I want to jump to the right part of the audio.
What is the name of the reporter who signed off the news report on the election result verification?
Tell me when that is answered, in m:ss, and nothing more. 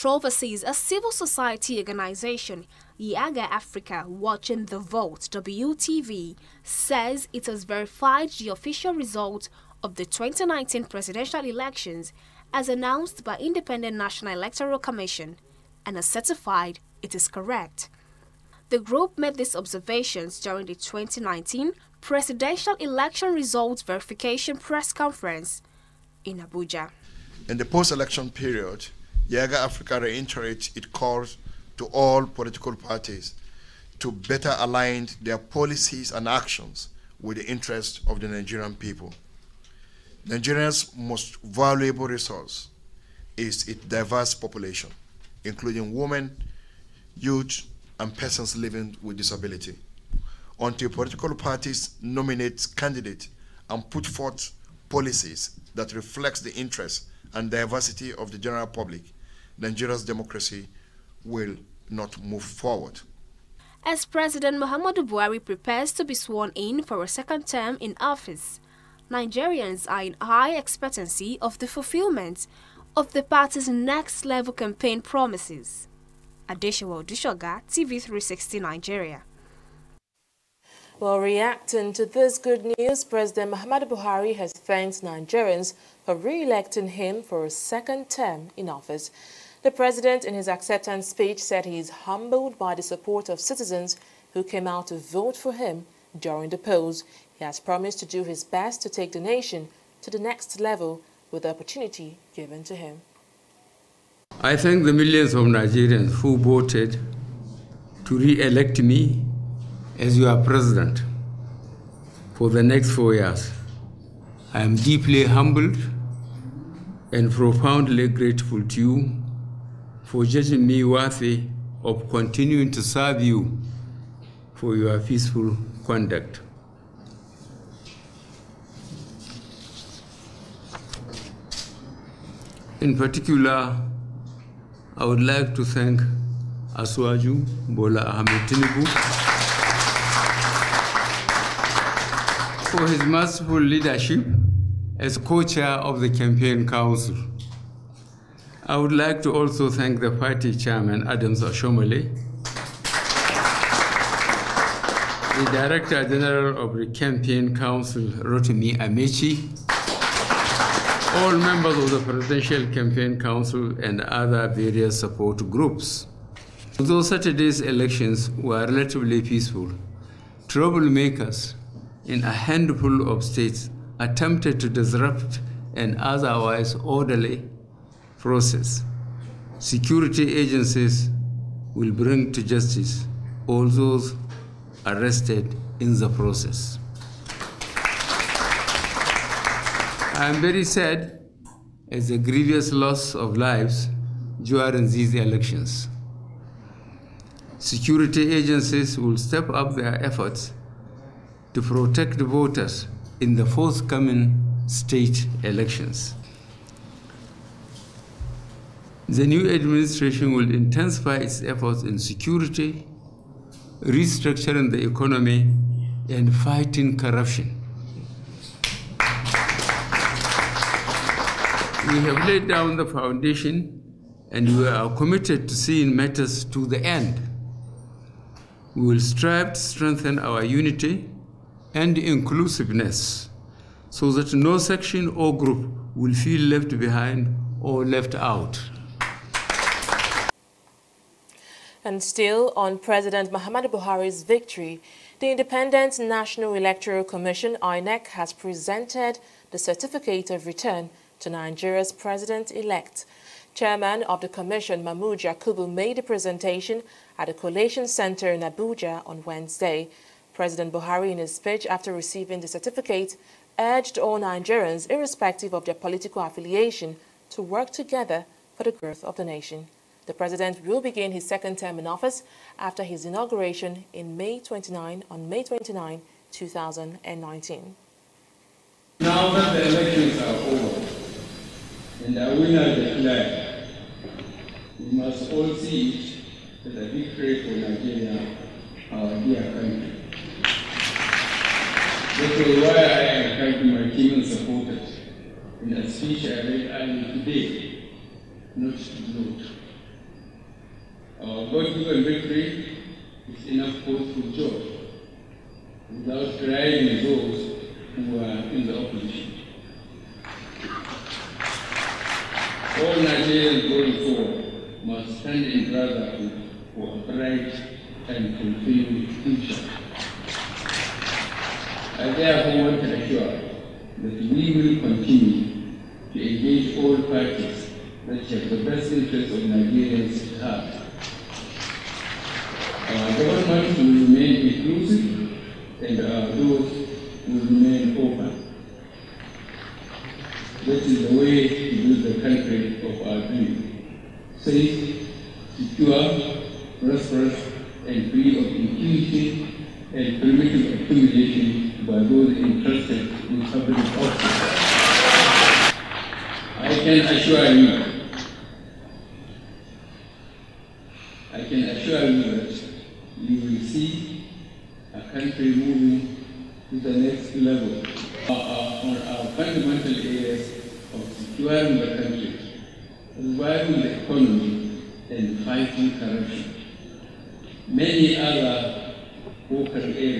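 1:16.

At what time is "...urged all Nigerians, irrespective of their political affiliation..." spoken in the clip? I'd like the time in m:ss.
4:23.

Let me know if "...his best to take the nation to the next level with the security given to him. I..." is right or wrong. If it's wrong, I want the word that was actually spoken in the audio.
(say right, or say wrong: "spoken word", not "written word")
wrong: "opportunity", not "security".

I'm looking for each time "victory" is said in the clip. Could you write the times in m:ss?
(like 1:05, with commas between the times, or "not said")
4:04, 4:46, 5:02.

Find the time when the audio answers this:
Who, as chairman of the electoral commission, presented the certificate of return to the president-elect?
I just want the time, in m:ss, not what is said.
4:14.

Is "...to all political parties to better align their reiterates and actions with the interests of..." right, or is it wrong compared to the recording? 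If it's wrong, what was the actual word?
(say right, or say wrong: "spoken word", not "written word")
wrong: "policies", not "reiterates".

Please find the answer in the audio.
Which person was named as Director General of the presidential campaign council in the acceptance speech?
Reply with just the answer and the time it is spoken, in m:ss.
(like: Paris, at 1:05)
Rotimi Amaechi, at 2:38.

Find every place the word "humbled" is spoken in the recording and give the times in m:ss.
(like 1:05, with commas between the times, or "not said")
1:31, 1:55.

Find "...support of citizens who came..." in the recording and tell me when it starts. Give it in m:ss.
1:32.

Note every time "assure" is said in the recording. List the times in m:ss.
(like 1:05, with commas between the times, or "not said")
5:22, 5:57, 6:01.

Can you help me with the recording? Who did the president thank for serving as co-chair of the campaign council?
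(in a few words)
Bola Ahmed Tinubu.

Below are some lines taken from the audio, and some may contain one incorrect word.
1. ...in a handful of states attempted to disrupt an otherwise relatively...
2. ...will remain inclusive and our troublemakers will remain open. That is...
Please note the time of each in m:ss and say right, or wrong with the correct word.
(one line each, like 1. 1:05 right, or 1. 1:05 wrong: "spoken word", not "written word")
1. 2:52 wrong: "orderly", not "relatively"
2. 5:33 wrong: "doors", not "troublemakers".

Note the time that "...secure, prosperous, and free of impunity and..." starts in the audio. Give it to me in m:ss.
5:45.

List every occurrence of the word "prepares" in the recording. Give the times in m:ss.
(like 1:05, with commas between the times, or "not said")
1:05.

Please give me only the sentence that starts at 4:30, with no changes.
The president will begin his second term in office after his inauguration in May 29 on May 29, 2019.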